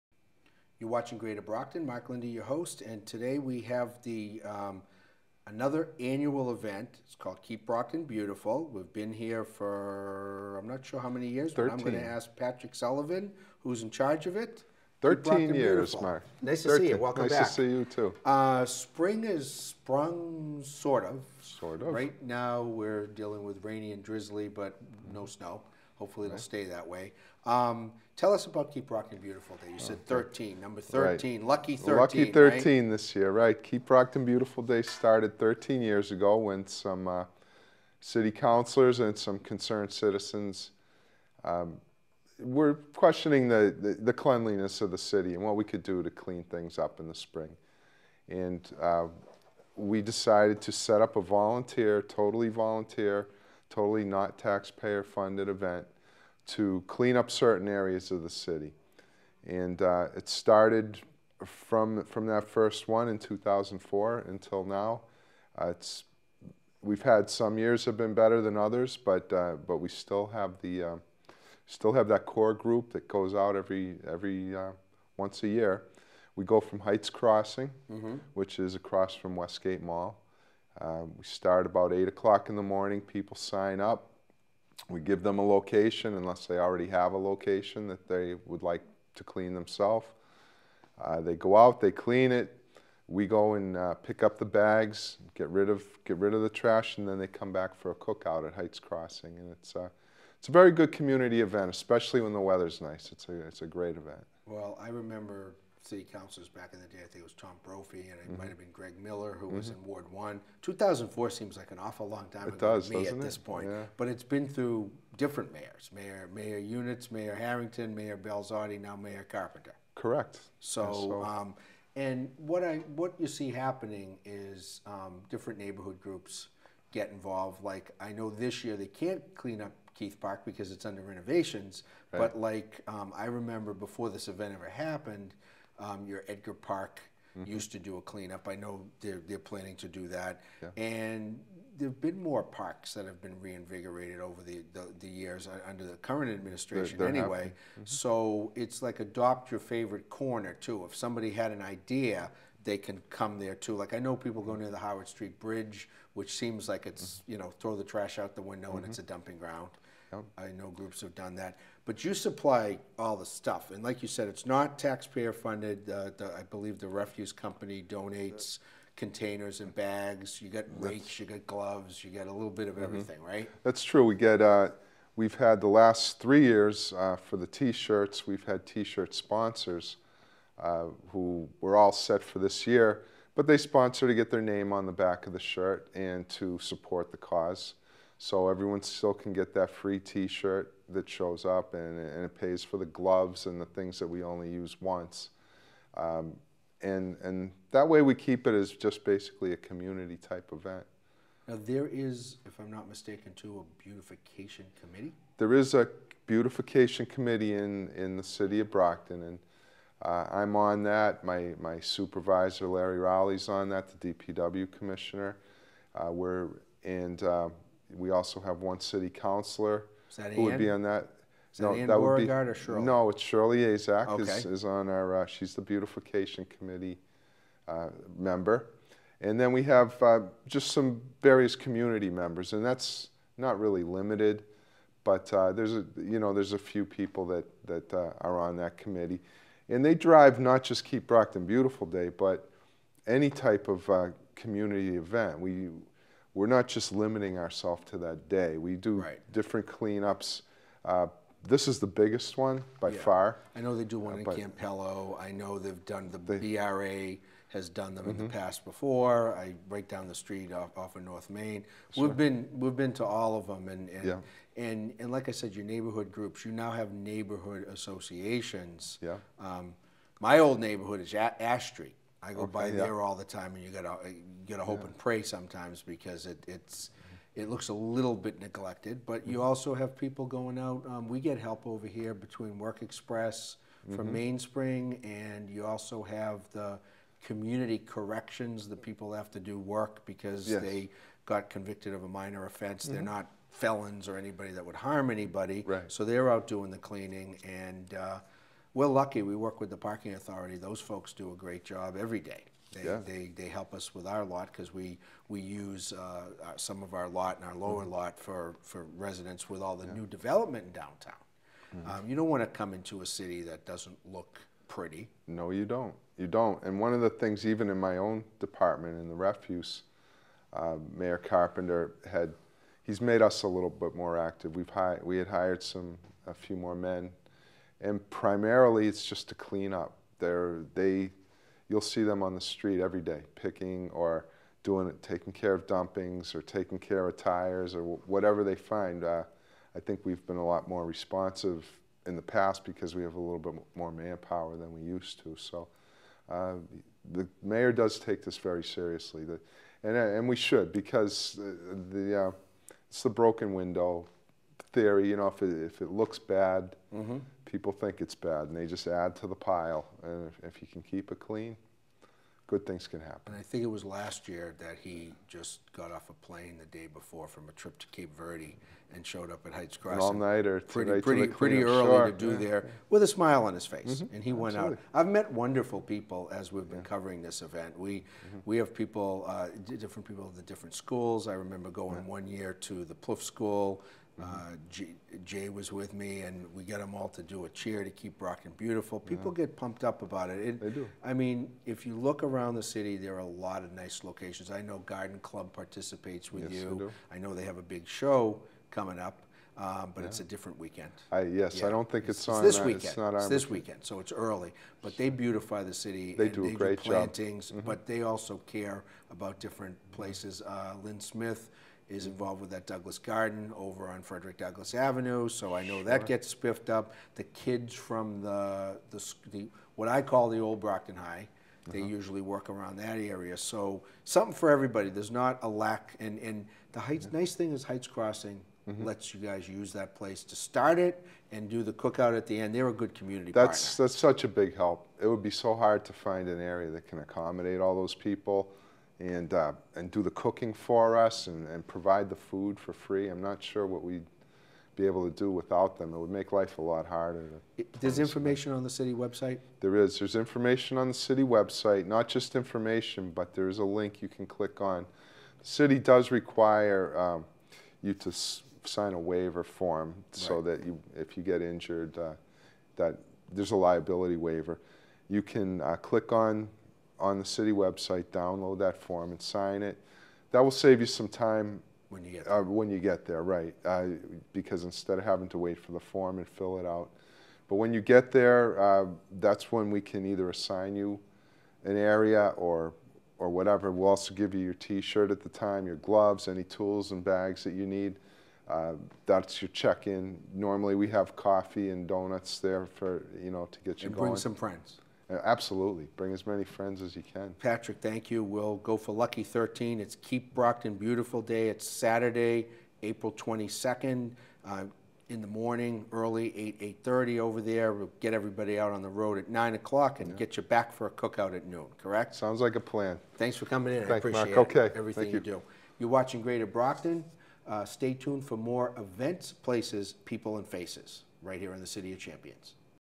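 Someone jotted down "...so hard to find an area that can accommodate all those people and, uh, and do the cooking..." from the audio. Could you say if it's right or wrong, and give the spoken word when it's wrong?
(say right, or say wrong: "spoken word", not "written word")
right.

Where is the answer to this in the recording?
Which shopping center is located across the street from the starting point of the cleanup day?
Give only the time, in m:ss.
1:19.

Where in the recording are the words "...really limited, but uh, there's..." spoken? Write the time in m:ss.
3:53.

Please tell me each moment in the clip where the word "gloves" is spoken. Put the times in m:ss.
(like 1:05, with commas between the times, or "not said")
2:51, 3:12, 8:05.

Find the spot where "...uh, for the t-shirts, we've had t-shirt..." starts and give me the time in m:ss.
2:56.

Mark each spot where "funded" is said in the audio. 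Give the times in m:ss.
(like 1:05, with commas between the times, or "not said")
0:55, 2:45.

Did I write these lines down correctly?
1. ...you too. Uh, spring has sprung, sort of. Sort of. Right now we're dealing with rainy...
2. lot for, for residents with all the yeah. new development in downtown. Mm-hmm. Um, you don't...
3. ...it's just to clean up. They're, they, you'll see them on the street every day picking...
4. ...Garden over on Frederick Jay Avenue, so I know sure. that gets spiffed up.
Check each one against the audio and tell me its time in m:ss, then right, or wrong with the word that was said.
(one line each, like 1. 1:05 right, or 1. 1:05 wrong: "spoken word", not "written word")
1. 0:17 right
2. 5:07 right
3. 5:28 right
4. 6:52 wrong: "Douglass", not "Jay".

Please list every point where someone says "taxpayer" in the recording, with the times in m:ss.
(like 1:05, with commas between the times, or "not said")
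0:54, 2:44.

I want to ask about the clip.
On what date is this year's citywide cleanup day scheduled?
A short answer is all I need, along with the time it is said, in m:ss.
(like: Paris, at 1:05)
April 22nd, at 8:22.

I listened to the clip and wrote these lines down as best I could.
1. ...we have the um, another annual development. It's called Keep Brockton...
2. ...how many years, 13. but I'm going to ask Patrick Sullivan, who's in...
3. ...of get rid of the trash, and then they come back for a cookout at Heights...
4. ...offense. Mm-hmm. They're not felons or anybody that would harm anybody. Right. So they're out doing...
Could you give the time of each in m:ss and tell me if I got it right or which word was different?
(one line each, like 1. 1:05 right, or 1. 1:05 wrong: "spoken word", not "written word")
1. 0:03 wrong: "event", not "development"
2. 0:10 right
3. 1:35 right
4. 4:52 right.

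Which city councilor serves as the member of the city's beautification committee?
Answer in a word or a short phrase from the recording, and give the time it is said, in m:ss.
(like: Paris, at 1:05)
Shirley Asack, at 3:43.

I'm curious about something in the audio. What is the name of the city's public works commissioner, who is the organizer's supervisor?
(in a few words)
Larry Rowley.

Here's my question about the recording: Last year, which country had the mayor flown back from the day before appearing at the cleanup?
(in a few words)
Cape Verde.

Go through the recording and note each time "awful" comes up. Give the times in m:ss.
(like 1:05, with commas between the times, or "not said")
1:51.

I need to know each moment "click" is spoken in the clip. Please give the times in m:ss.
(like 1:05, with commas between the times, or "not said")
7:34, 7:45.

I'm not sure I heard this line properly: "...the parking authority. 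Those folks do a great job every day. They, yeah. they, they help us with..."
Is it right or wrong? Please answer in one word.
right.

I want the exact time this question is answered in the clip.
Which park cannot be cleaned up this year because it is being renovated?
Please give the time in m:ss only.
2:09.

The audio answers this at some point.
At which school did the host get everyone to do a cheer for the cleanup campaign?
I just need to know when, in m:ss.
6:23.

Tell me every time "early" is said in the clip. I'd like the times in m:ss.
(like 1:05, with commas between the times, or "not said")
6:11, 6:44, 8:25.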